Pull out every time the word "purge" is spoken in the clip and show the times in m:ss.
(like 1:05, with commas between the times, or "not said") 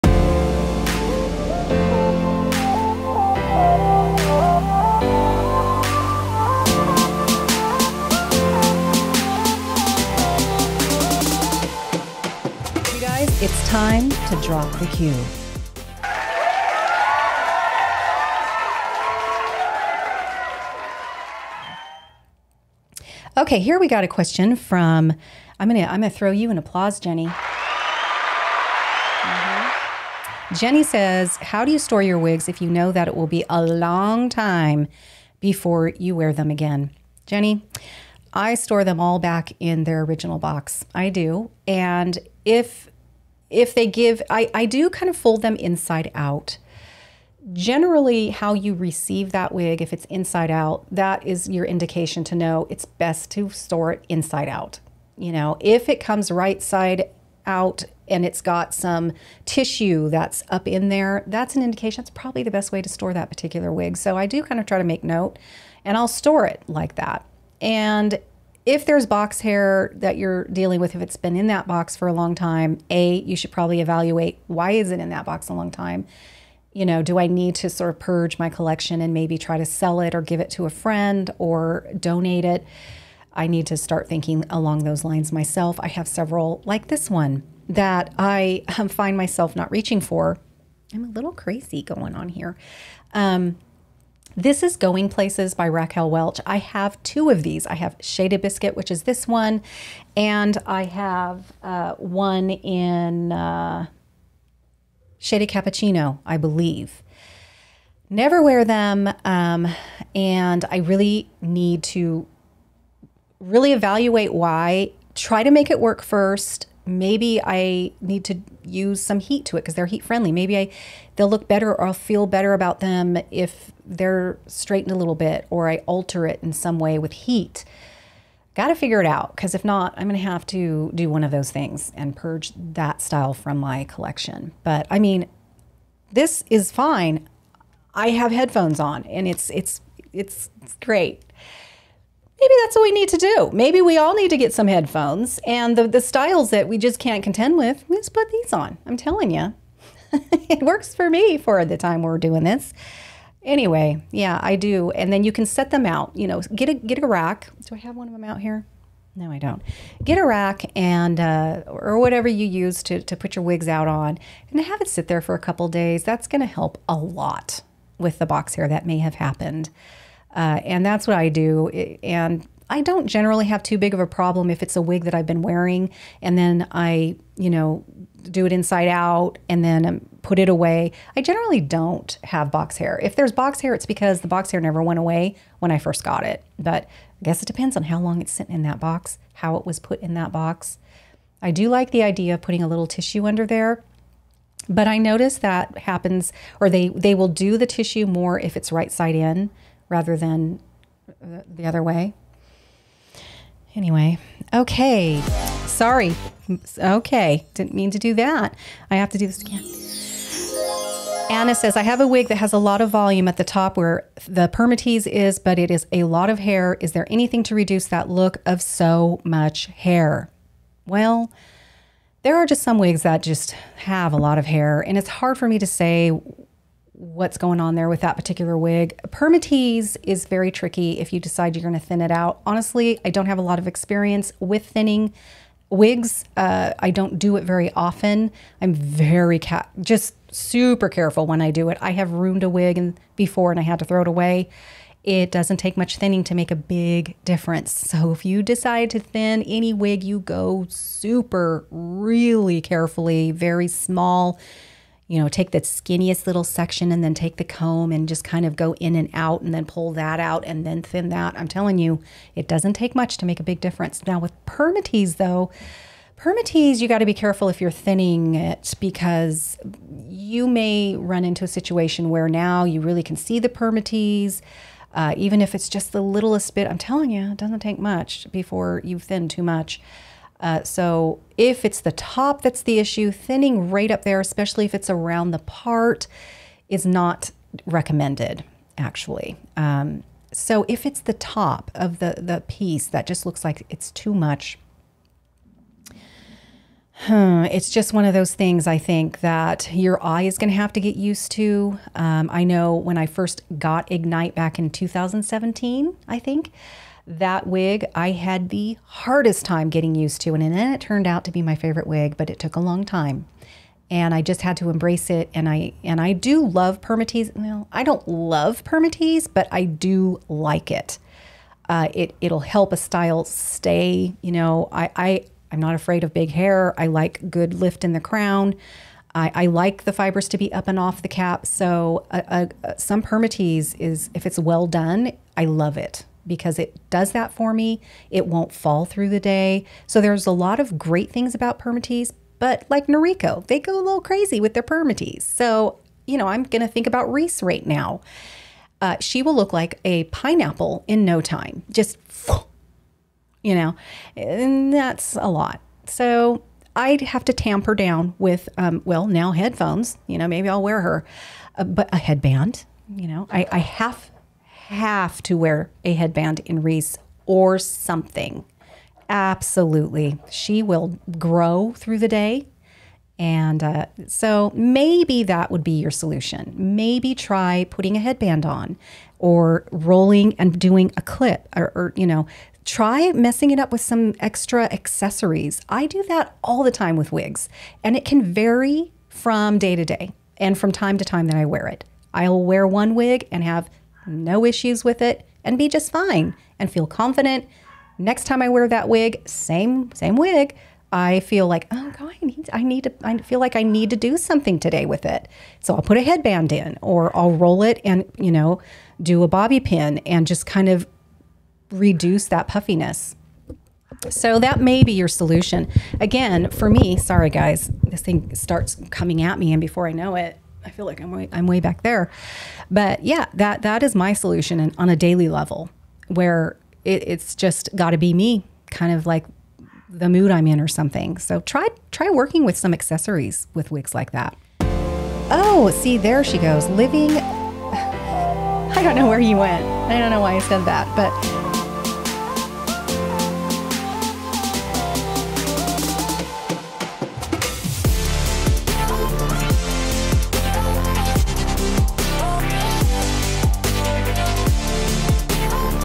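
1:17, 2:12.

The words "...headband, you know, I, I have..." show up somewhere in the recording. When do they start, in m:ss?
6:01.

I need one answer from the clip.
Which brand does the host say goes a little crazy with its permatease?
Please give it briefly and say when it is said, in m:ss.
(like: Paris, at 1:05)
Noriko, at 5:42.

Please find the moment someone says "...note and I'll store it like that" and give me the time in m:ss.
1:05.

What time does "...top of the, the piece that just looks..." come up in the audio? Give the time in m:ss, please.
4:51.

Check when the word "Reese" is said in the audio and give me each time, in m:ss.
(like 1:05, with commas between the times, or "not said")
5:47, 6:06.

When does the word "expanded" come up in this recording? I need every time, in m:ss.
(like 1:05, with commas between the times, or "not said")
not said.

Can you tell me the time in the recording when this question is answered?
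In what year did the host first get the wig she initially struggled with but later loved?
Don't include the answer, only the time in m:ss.
5:04.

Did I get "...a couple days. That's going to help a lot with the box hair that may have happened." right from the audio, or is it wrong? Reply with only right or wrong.
right.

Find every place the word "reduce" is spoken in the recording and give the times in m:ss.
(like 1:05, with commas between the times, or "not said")
3:37, 6:51.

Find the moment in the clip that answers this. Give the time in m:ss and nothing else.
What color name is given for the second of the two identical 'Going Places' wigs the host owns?
1:45.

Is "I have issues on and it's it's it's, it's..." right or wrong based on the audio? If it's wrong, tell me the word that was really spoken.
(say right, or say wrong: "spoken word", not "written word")
wrong: "headphones", not "issues".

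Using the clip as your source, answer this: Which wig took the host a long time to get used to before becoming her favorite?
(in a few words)
Ignite.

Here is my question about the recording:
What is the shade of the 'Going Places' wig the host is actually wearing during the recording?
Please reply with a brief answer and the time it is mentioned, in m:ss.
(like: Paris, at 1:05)
Shaded Biscuit, at 1:37.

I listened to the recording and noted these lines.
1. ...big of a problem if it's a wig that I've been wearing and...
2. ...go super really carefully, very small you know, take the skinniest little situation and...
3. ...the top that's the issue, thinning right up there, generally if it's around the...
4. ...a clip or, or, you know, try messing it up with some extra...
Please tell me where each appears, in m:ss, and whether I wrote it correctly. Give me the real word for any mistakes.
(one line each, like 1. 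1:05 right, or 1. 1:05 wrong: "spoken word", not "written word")
1. 2:53 right
2. 4:10 wrong: "section", not "situation"
3. 4:41 wrong: "especially", not "generally"
4. 6:20 right.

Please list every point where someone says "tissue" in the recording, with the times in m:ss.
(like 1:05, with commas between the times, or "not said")
0:59, 3:12, 3:17.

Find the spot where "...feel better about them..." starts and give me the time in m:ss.
2:01.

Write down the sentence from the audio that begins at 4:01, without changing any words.
I have ruined a wig and before and I had to throw it away.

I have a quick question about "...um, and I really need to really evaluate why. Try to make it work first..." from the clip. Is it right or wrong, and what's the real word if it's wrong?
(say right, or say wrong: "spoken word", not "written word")
right.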